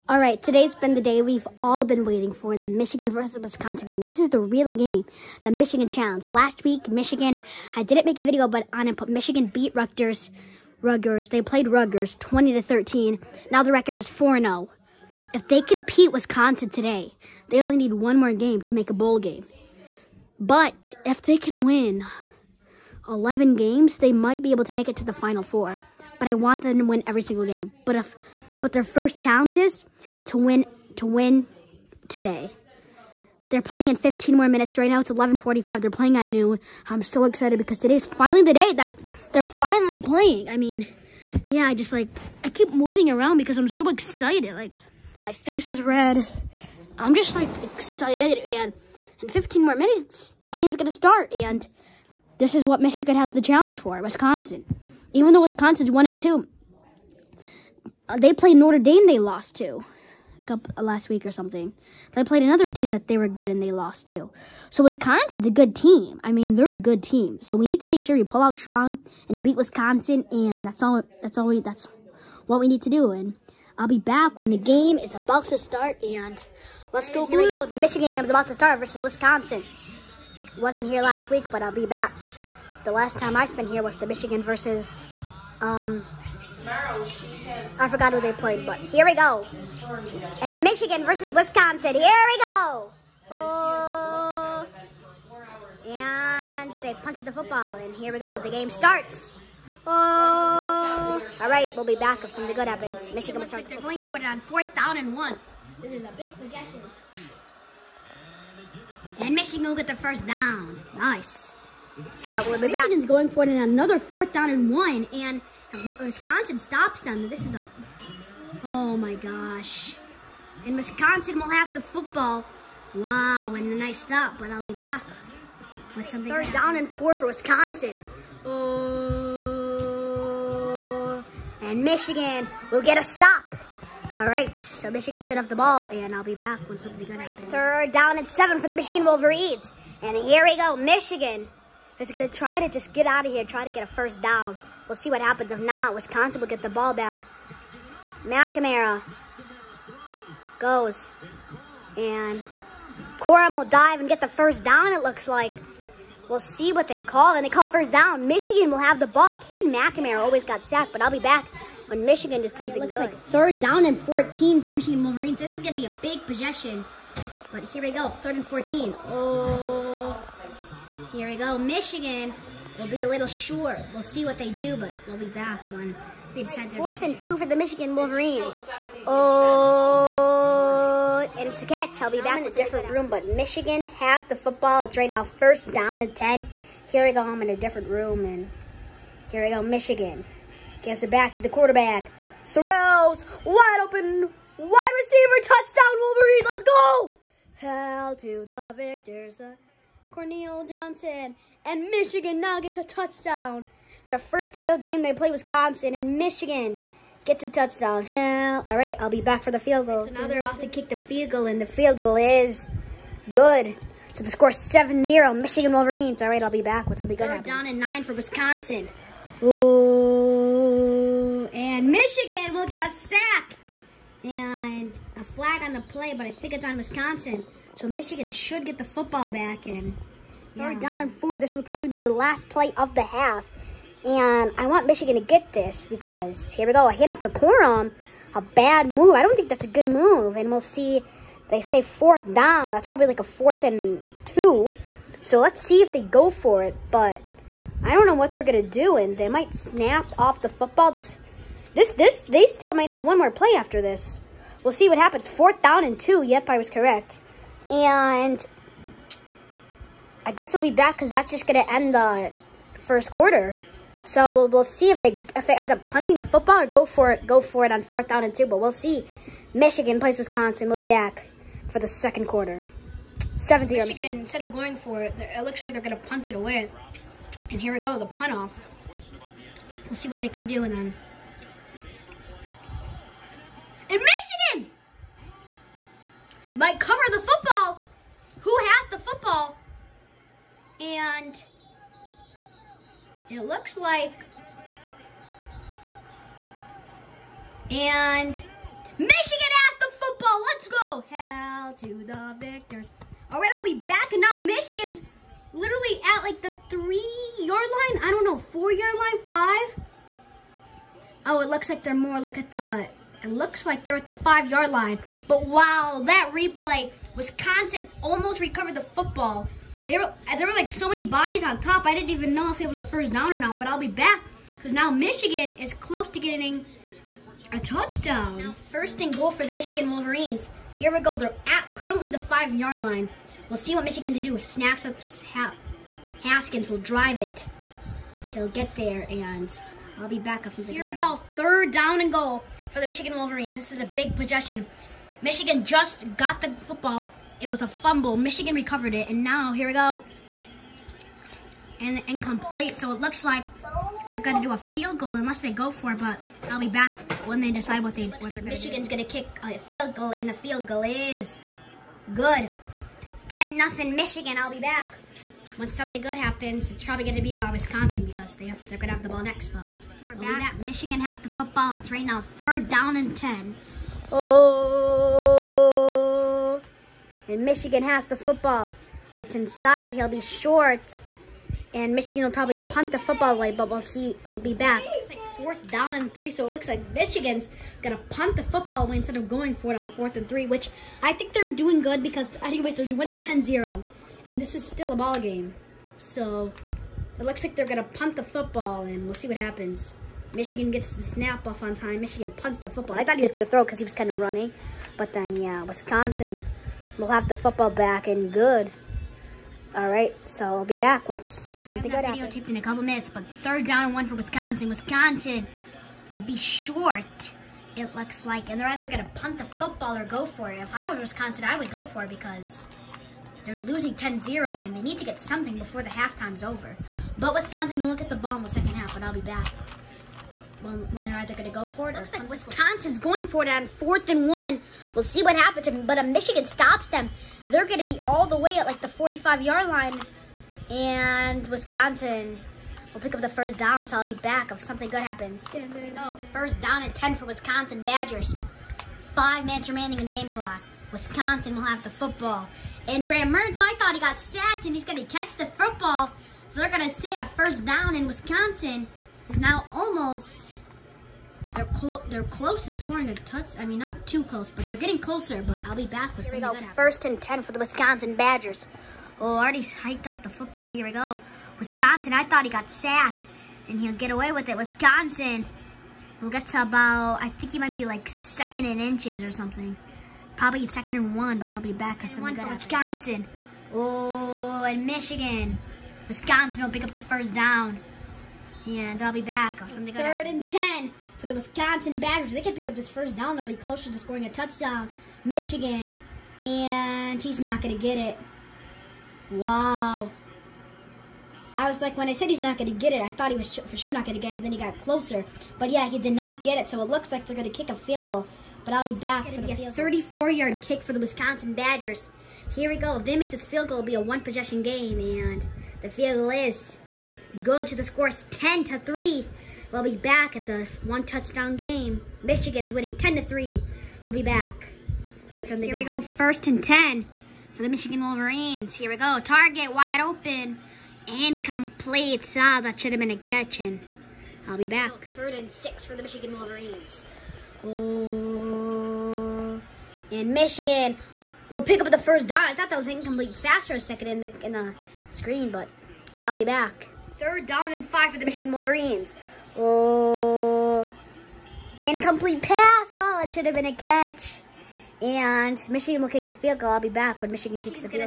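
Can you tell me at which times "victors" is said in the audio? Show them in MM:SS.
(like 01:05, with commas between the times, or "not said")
03:18, 05:02.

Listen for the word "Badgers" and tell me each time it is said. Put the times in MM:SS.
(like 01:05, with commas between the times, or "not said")
07:27, 07:48, 08:11, 08:31.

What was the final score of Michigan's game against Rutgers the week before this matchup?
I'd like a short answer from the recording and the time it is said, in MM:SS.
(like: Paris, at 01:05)
20 to 13, at 00:12.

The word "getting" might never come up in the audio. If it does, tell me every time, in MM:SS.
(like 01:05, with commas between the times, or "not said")
05:26, 07:44.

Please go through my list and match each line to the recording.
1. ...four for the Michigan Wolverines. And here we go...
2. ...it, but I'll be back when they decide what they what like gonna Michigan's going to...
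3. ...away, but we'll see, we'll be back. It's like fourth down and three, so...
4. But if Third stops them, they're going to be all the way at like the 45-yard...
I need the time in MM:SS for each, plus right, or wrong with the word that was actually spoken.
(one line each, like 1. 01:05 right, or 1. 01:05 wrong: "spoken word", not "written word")
1. 02:18 wrong: "seven", not "four"
2. 05:55 right
3. 06:23 right
4. 07:15 wrong: "Michigan", not "Third".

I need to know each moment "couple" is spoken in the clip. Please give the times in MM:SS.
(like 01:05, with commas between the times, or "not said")
01:00, 06:52.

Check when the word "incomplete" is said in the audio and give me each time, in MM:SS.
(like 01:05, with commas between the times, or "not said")
05:52, 08:51, 09:02, 09:11.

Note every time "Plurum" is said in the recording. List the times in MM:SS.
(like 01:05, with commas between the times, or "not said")
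03:57.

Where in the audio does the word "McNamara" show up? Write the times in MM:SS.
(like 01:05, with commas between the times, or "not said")
02:28, 02:39.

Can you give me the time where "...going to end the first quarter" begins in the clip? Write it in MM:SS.
04:21.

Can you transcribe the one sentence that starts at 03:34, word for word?
So the score 7-0, Michigan Wolverines.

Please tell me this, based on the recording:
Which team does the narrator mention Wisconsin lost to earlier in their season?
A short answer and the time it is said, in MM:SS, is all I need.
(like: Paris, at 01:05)
Notre Dame, at 00:58.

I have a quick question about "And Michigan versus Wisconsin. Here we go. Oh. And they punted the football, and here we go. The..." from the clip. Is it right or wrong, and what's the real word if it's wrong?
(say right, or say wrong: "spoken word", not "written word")
right.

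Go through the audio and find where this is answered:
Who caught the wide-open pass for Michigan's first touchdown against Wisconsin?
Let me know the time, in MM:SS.
03:20.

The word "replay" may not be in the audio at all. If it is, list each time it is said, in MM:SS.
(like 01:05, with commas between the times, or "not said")
05:16.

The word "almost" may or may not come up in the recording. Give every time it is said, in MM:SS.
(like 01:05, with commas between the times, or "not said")
05:18, 07:39.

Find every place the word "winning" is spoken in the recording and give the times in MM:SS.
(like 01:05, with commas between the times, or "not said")
06:32, 08:42.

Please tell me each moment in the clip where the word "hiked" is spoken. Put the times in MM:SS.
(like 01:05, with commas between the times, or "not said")
07:49.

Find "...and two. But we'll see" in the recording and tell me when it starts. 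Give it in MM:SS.
04:28.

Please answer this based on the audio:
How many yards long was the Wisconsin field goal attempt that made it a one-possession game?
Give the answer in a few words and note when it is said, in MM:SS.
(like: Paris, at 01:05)
34, at 08:29.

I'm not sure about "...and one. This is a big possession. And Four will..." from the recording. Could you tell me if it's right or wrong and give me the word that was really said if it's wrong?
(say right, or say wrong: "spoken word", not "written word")
wrong: "Michigan", not "Four".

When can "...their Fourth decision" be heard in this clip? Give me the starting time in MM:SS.
02:56.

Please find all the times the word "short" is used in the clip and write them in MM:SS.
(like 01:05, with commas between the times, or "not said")
02:53, 06:20, 06:56.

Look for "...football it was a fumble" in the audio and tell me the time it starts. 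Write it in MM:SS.
05:46.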